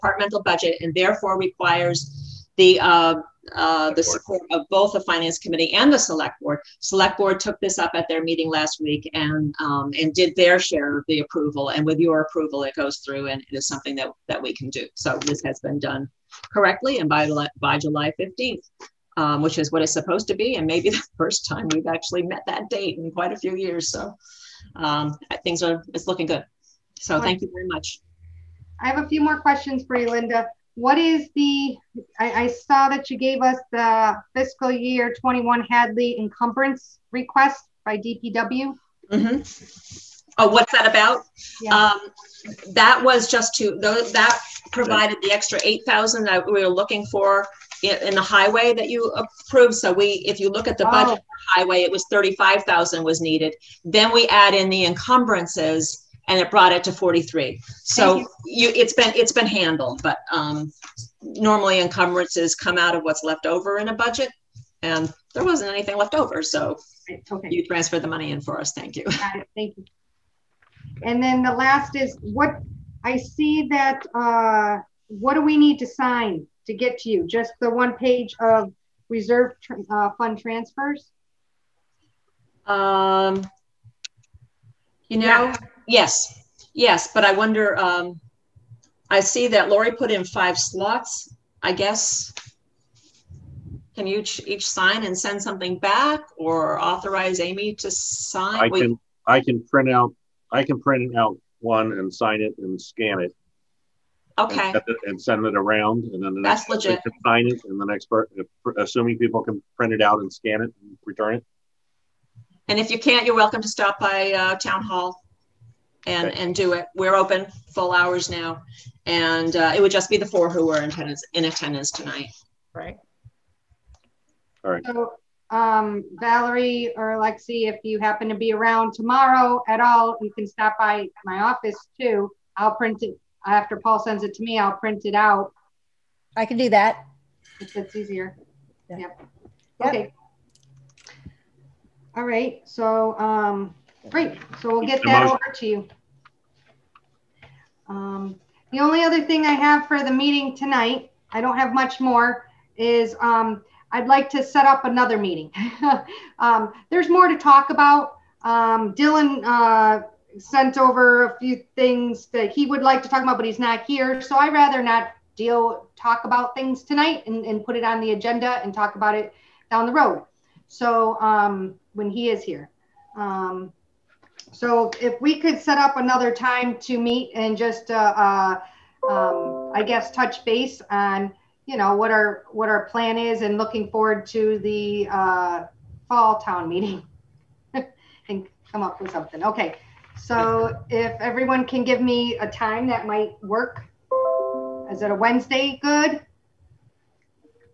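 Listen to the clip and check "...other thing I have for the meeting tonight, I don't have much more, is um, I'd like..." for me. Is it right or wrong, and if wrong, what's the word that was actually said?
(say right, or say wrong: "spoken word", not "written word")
right.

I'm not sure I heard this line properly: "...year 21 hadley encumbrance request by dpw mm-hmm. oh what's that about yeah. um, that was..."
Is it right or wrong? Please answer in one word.
right.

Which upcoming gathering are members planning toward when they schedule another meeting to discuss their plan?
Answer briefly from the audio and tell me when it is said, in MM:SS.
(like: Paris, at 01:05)
fall town meeting, at 03:06.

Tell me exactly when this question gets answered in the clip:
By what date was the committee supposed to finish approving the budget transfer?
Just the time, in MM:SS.
00:17.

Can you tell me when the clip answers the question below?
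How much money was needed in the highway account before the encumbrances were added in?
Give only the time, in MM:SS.
00:52.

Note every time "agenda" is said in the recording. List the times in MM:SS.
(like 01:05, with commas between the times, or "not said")
02:48.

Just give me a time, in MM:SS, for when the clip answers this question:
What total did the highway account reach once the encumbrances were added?
00:56.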